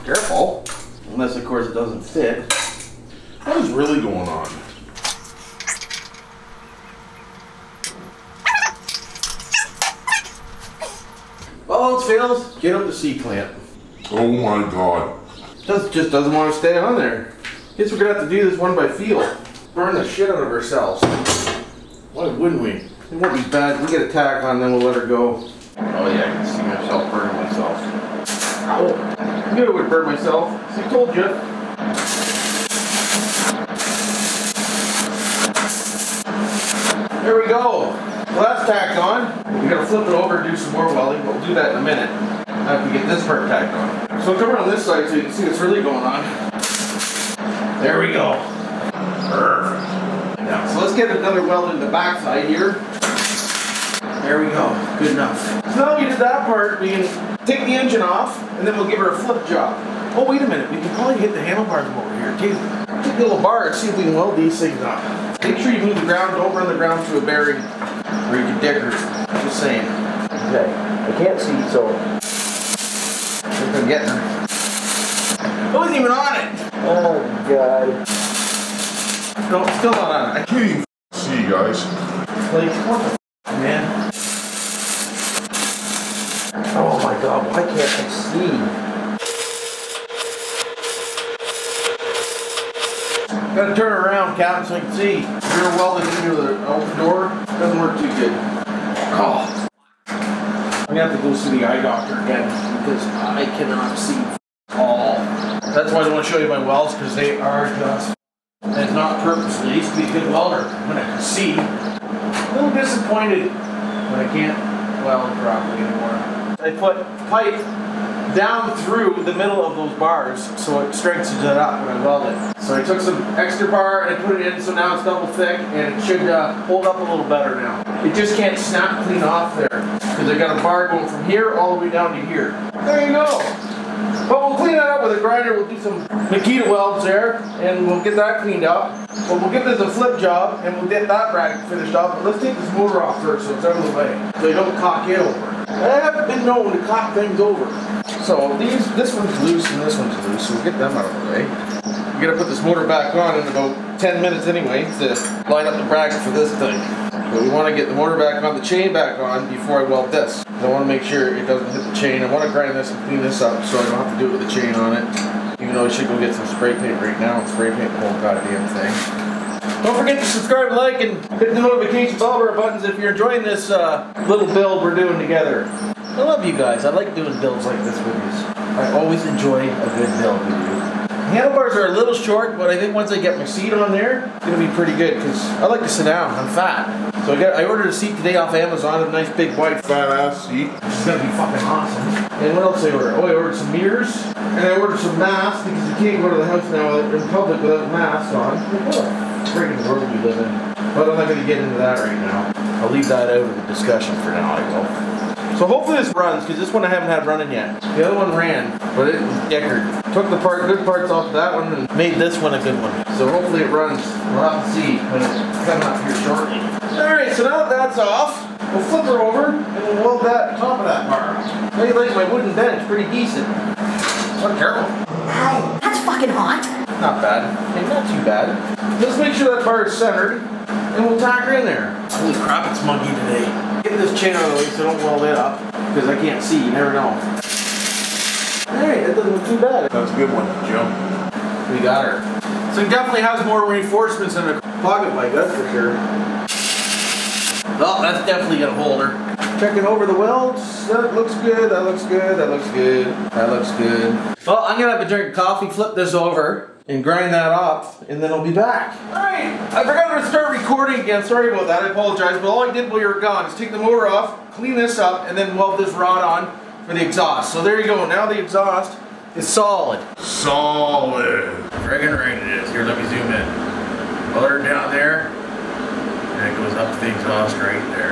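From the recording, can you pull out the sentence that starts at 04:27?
So there you go, now the exhaust is solid.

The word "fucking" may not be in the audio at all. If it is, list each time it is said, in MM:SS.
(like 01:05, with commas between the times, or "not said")
03:11, 03:46.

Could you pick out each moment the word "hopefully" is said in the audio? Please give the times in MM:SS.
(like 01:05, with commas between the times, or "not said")
03:25, 03:33.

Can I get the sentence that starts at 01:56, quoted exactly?
I put pipe down through the middle of those bars so it strengthens it up when I weld it.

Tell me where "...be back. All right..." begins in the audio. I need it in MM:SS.
04:18.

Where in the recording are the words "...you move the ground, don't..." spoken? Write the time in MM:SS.
01:05.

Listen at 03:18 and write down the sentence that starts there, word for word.
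What Freaking world we live in.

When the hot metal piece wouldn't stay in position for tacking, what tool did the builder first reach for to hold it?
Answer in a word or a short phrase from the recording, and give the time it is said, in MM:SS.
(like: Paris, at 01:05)
C-clamp, at 00:12.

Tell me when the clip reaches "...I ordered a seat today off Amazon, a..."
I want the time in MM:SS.
03:07.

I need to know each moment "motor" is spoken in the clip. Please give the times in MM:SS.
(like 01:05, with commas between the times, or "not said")
02:22, 02:32, 02:37, 04:23, 04:34.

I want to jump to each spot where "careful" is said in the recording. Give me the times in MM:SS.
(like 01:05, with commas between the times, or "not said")
00:00, 03:44.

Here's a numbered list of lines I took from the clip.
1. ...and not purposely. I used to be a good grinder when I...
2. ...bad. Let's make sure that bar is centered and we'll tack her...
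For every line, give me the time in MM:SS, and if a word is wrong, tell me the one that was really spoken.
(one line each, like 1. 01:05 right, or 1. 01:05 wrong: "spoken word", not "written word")
1. 01:48 wrong: "welder", not "grinder"
2. 03:48 right.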